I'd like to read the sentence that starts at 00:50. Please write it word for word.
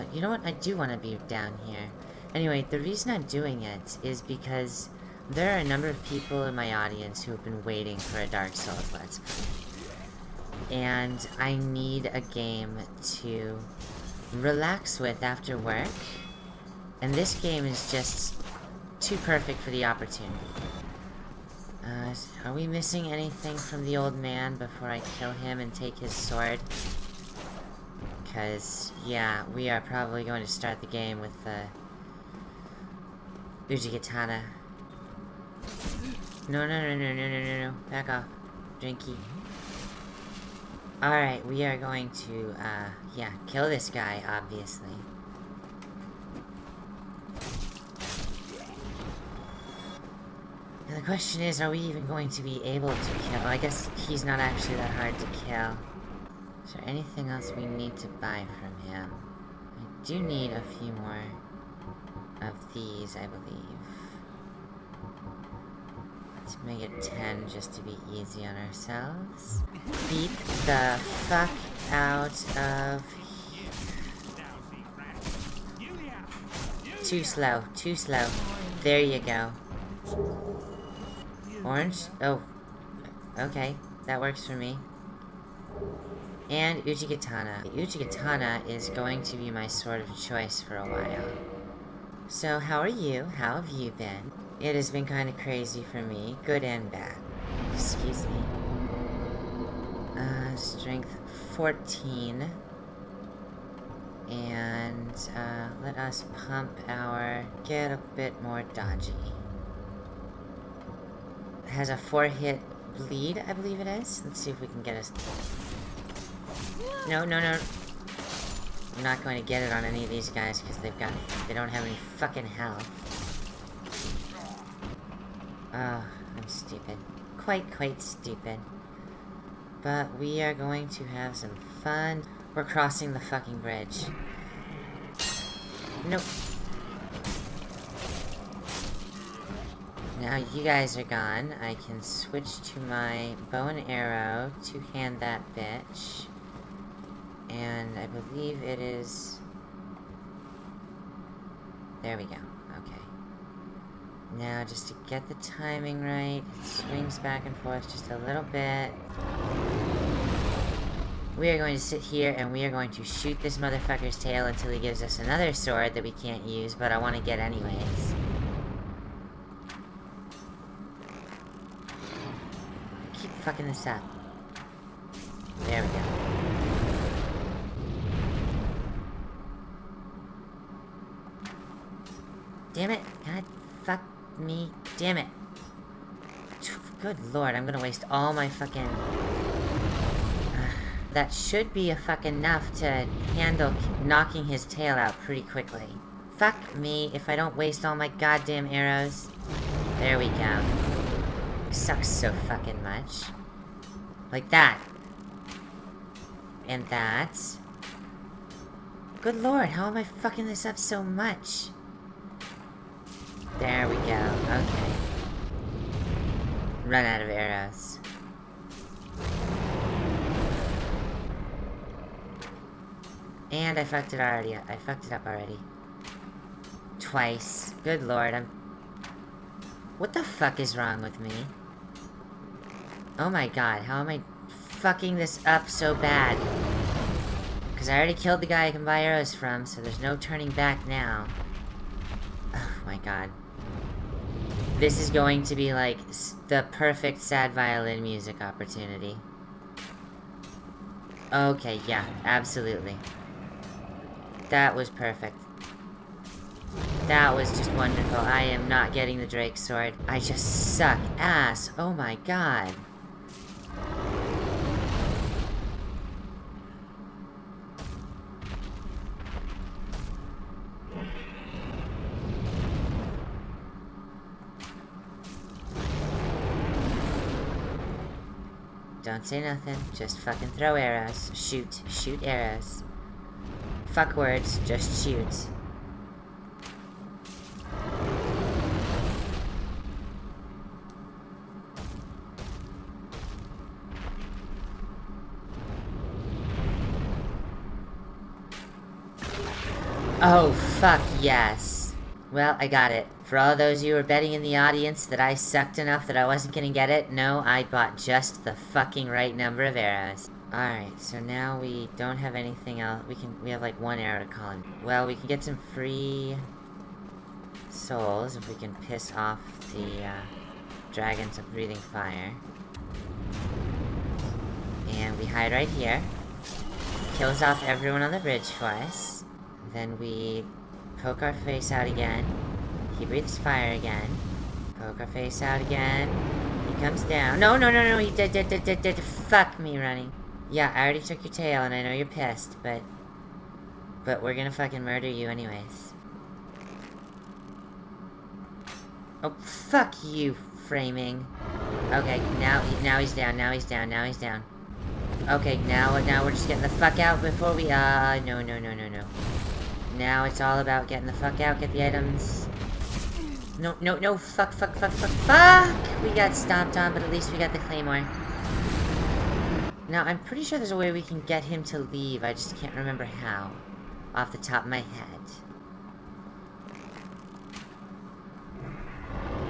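And the question is, are we even going to be able to kill?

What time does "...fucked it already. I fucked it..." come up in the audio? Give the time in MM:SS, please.
03:43.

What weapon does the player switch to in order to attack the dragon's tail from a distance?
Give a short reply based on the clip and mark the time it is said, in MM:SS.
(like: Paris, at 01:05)
Bow and arrow, at 02:23.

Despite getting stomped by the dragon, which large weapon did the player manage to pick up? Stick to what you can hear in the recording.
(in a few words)
Claymore.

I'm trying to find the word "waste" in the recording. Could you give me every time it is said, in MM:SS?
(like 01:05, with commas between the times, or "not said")
03:07, 03:17.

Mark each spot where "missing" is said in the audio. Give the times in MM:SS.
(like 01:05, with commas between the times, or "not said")
00:22.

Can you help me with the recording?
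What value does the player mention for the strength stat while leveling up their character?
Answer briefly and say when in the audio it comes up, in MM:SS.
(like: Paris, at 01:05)
14, at 01:40.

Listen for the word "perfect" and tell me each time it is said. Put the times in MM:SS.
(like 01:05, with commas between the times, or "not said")
00:19, 04:06, 04:14.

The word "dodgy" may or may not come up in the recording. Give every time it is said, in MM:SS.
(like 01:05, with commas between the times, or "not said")
01:48.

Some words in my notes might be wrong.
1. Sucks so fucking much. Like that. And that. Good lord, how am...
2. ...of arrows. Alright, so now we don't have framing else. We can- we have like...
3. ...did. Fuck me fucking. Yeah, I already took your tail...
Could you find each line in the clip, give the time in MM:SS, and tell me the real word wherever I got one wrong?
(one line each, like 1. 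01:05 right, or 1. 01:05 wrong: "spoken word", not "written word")
1. 03:21 right
2. 05:09 wrong: "anything", not "framing"
3. 05:38 wrong: "running", not "fucking".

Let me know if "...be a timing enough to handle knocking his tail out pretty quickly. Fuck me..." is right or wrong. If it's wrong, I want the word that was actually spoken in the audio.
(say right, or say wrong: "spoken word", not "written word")
wrong: "fucking", not "timing".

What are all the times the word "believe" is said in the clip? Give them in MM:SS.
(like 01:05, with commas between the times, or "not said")
01:03, 01:53, 02:28.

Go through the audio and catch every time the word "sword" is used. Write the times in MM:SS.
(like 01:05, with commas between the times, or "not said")
00:26, 01:29, 02:45, 04:19.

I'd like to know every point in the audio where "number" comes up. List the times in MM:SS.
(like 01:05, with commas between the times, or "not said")
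00:05, 05:09.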